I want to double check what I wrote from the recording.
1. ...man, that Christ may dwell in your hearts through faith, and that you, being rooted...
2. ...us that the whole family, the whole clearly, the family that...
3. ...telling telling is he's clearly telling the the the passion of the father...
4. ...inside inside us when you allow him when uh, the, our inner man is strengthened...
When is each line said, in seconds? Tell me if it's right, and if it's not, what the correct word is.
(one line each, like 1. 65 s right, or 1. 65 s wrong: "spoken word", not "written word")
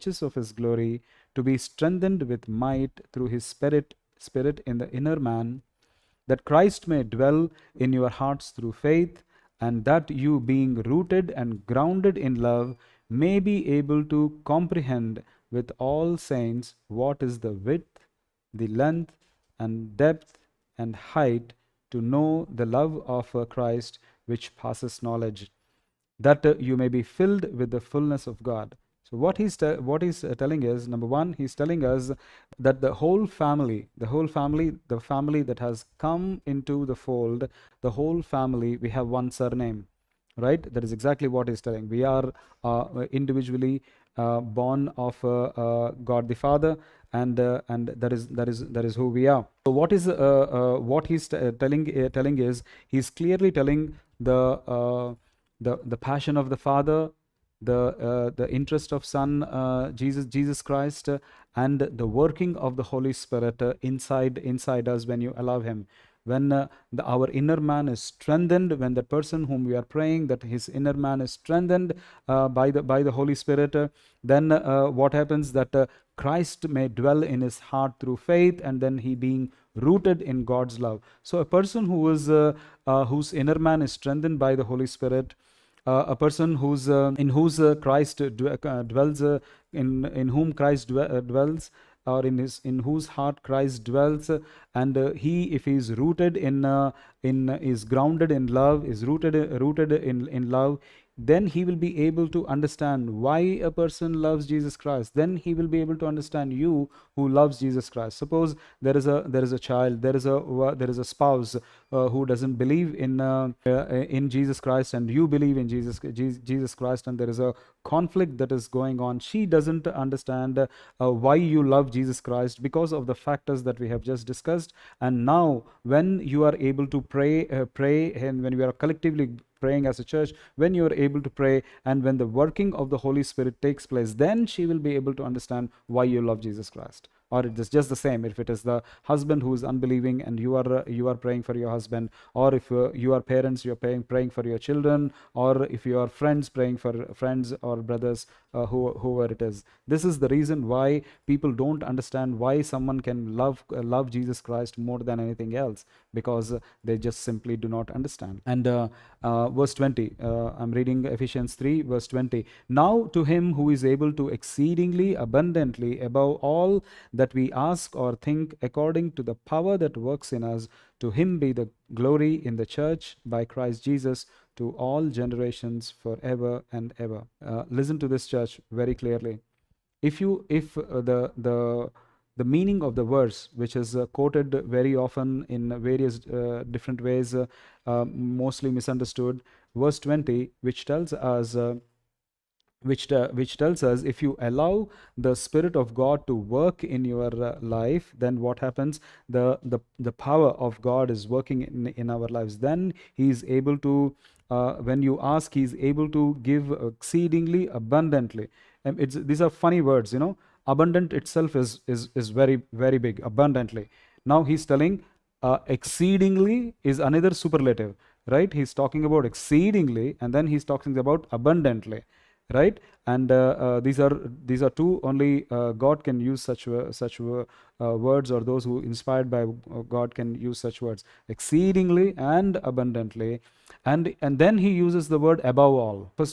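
1. 5 s right
2. 31 s wrong: "family", not "clearly"
3. 51 s right
4. 63 s right.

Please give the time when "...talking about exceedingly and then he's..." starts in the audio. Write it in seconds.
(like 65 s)
218 s.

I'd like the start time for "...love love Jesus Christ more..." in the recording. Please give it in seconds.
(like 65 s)
153 s.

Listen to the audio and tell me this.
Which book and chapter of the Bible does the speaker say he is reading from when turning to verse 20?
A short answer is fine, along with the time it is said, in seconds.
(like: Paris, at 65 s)
Ephesians 3, at 161 s.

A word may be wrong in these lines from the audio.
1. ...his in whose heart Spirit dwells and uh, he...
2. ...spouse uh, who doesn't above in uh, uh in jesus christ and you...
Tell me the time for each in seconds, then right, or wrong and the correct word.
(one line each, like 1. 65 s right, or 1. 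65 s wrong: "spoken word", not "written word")
1. 92 s wrong: "Christ", not "Spirit"
2. 111 s wrong: "believe", not "above".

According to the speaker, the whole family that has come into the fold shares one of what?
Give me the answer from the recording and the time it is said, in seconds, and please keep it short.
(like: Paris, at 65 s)
surname, at 39 s.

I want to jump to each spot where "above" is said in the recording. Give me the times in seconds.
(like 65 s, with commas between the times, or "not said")
166 s, 235 s.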